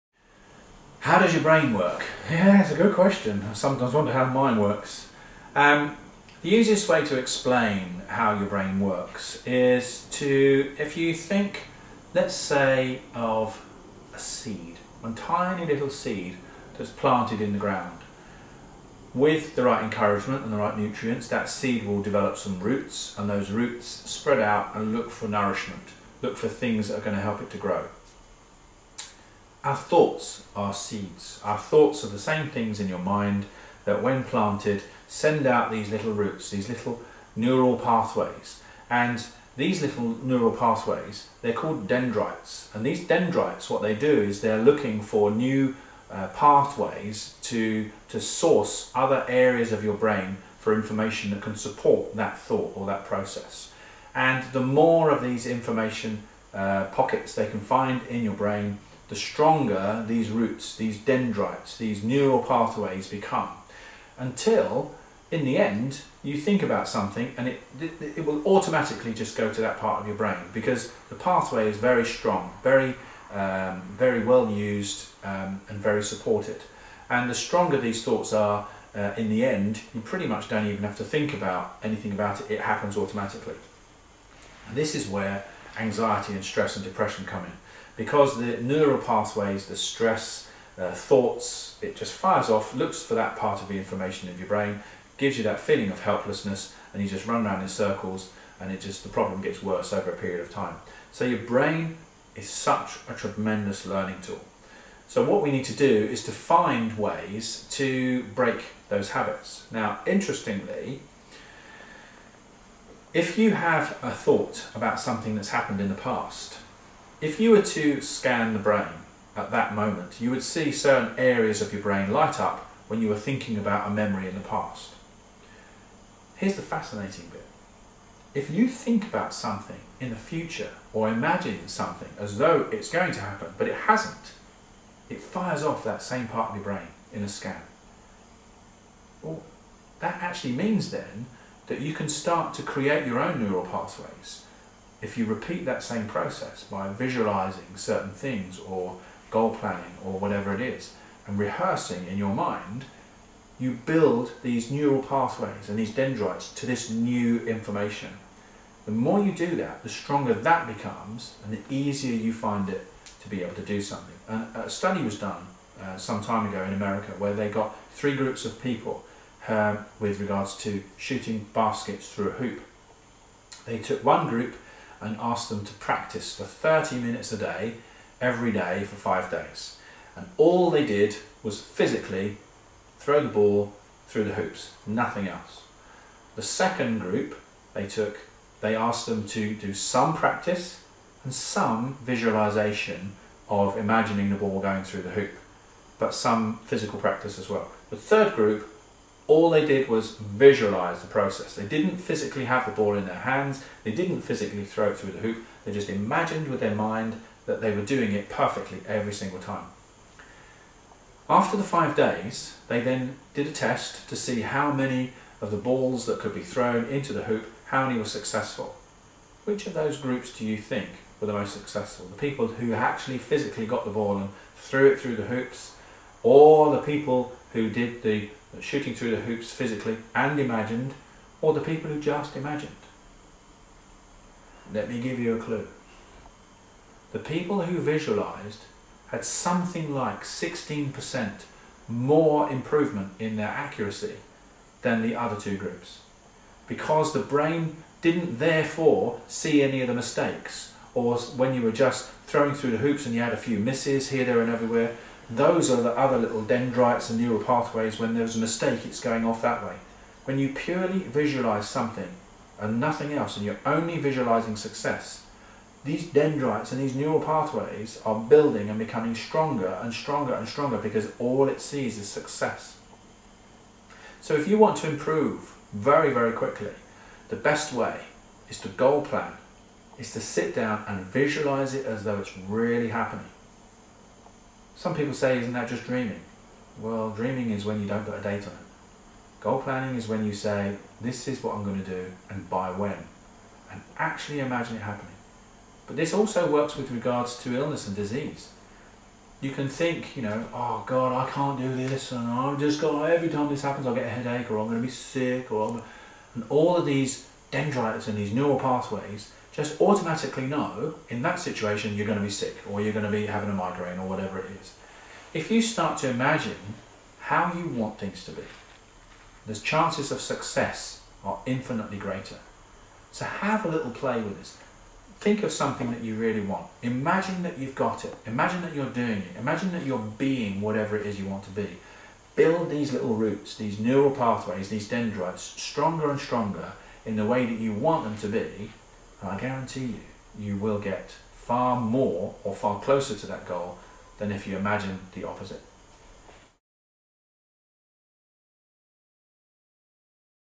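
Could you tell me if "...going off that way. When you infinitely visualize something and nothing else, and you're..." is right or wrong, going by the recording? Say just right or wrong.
wrong.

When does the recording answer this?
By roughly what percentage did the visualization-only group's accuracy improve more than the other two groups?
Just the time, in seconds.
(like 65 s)
240 s.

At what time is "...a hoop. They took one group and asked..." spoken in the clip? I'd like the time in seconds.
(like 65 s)
172 s.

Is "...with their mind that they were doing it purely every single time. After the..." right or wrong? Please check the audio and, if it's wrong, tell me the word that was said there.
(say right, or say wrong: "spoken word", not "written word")
wrong: "perfectly", not "purely".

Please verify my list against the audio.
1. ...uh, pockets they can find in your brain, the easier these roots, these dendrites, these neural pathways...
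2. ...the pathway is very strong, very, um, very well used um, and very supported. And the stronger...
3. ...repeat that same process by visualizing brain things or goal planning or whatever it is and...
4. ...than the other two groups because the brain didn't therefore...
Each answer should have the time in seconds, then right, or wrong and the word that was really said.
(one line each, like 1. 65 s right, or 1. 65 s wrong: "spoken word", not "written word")
1. 56 s wrong: "stronger", not "easier"
2. 71 s right
3. 145 s wrong: "certain", not "brain"
4. 244 s right.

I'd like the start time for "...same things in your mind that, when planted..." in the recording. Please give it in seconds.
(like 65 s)
32 s.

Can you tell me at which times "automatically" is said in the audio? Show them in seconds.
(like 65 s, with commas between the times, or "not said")
68 s, 82 s, 309 s.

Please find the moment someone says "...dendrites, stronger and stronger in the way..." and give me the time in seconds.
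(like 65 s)
334 s.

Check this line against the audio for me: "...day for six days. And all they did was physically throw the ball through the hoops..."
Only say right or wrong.
wrong.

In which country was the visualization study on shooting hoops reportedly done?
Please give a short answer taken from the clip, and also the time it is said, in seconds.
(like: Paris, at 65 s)
America, at 166 s.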